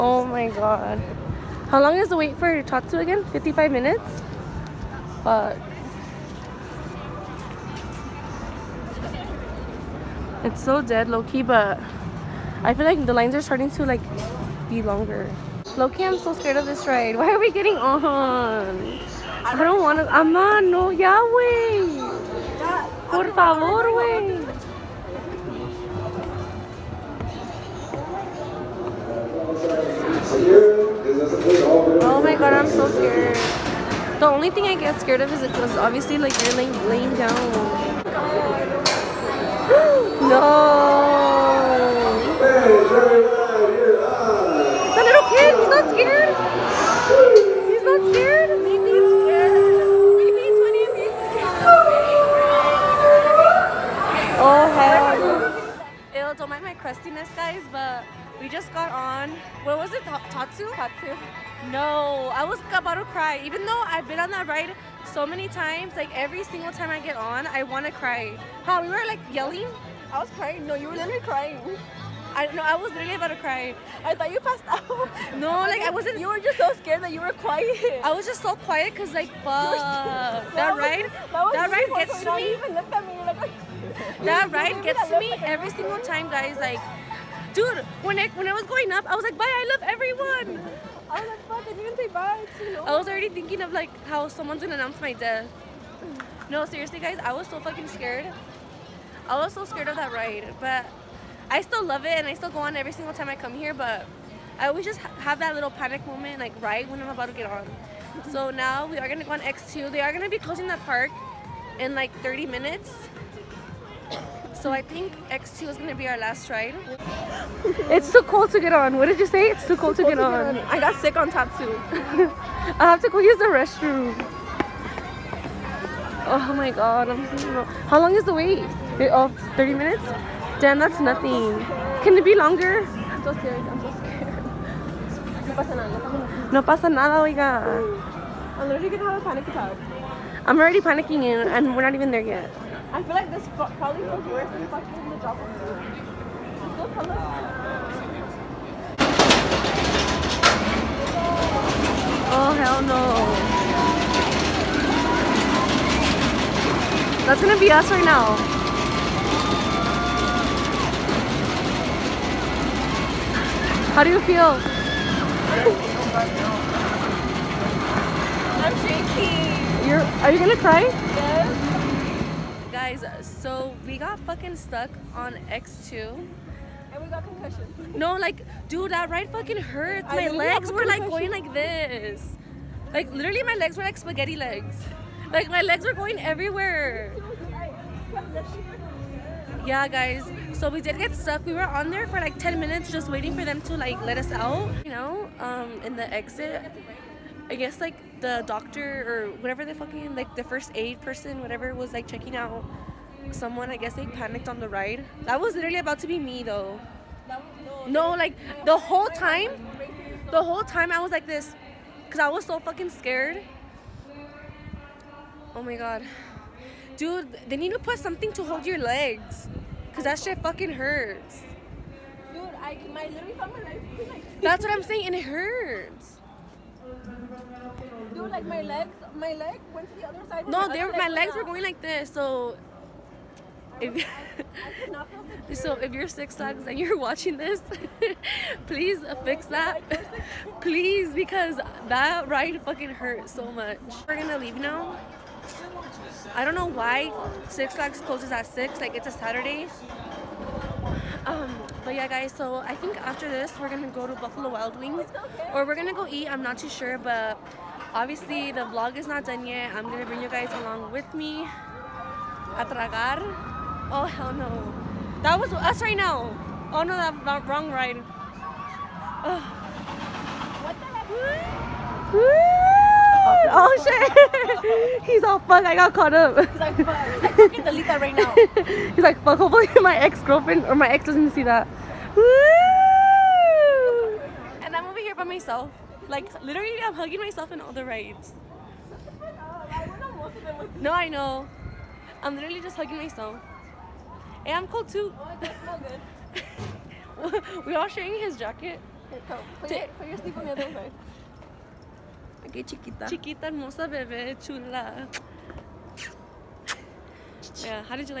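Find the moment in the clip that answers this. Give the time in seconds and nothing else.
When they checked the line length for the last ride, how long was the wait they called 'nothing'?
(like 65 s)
129 s.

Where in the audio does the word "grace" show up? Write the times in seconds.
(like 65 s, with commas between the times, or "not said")
not said.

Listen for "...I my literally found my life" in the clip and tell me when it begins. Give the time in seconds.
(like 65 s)
222 s.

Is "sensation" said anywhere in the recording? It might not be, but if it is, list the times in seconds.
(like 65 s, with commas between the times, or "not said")
not said.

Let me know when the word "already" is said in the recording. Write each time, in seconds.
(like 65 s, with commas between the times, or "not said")
93 s, 140 s.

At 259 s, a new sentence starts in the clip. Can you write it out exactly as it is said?
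I'm gonna bring you guys along with me.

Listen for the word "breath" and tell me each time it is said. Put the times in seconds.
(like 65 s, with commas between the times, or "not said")
not said.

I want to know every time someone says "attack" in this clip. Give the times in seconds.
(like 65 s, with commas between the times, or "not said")
139 s.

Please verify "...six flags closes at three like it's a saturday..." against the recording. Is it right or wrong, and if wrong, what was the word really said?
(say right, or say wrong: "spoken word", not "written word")
wrong: "six", not "three".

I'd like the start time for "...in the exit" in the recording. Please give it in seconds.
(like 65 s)
195 s.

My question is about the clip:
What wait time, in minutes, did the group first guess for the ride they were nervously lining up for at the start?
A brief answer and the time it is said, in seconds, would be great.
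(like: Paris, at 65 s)
55 minutes, at 3 s.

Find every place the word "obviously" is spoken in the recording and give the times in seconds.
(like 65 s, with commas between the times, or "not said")
35 s, 257 s.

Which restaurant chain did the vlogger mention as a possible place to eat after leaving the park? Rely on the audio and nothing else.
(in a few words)
Buffalo Wild Wings.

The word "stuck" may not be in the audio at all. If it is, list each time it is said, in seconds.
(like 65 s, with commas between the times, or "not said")
174 s, 191 s.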